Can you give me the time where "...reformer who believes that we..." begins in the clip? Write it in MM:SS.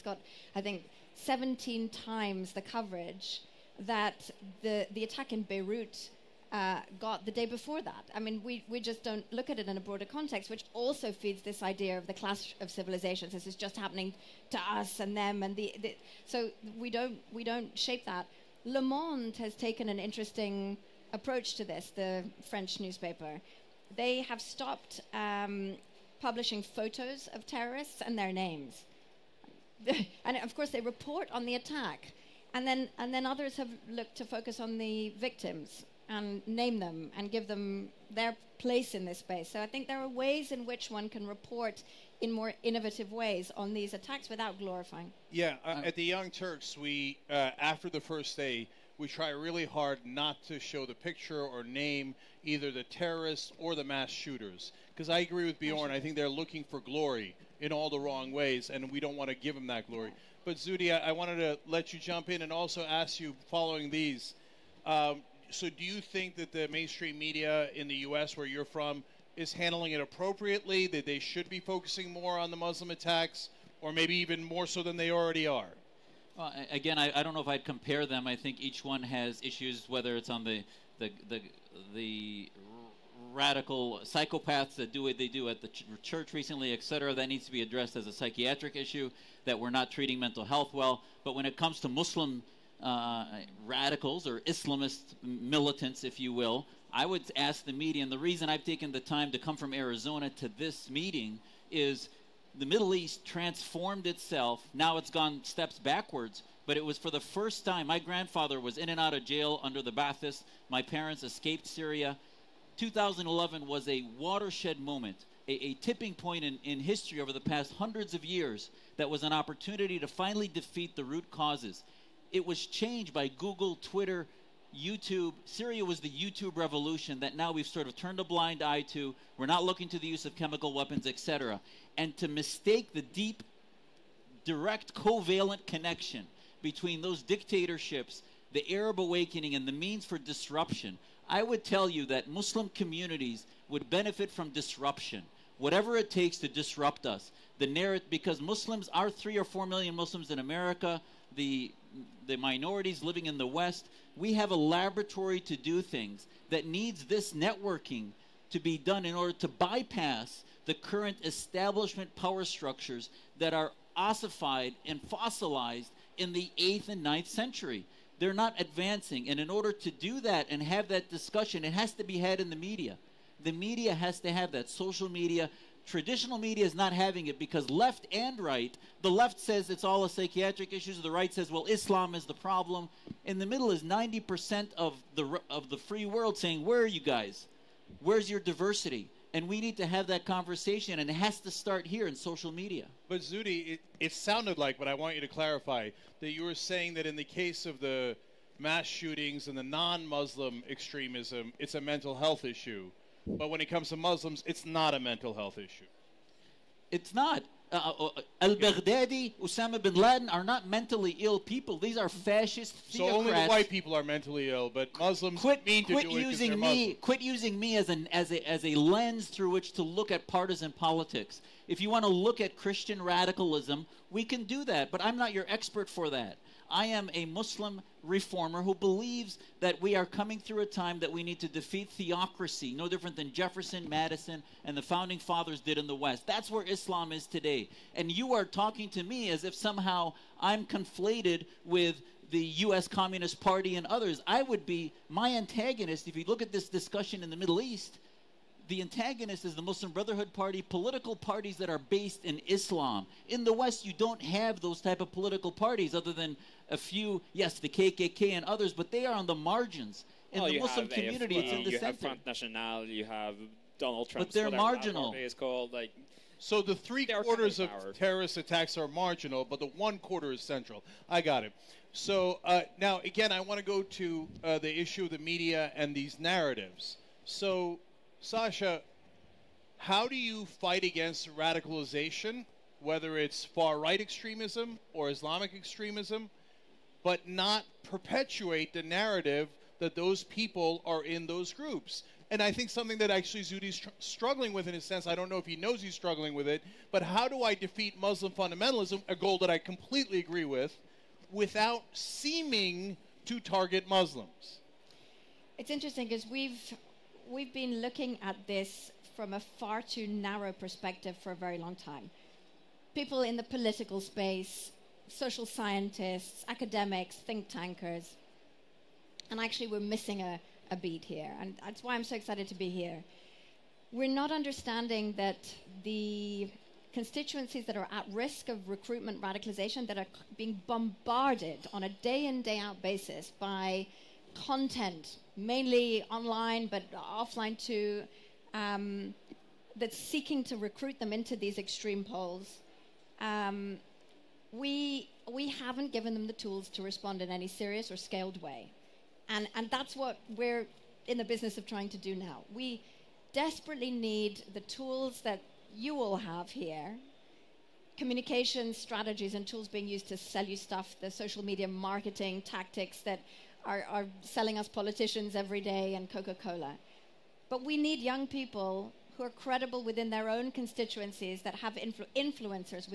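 03:48.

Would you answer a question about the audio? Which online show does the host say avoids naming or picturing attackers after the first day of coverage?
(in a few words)
The Young Turks.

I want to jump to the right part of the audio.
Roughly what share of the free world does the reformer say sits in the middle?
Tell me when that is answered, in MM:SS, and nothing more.
03:03.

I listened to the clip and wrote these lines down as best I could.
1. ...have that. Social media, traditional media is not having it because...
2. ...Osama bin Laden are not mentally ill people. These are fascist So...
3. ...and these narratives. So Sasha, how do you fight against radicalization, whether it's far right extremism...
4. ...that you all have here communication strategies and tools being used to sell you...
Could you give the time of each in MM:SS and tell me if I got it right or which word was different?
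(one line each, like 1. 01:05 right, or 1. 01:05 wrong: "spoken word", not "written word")
1. 02:54 right
2. 03:29 right
3. 04:35 right
4. 05:55 right.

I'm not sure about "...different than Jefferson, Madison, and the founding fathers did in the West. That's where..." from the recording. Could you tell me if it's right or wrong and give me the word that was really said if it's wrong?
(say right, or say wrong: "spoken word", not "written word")
right.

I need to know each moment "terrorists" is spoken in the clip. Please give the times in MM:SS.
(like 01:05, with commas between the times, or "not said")
00:27, 00:52, 04:27.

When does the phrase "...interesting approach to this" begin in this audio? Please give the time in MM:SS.
00:19.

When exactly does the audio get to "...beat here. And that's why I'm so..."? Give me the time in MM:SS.
05:20.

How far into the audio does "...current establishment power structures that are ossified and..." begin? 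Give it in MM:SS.
02:40.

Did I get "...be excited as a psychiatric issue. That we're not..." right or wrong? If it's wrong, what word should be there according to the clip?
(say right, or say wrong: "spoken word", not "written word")
wrong: "addressed", not "excited".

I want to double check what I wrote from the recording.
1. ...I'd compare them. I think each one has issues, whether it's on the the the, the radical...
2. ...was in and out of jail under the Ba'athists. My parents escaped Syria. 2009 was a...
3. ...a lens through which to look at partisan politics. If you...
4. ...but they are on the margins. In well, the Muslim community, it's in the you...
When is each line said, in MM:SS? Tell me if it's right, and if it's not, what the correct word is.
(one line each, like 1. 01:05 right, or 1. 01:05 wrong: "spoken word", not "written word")
1. 01:17 right
2. 01:48 wrong: "2011", not "2009"
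3. 03:38 right
4. 04:18 right.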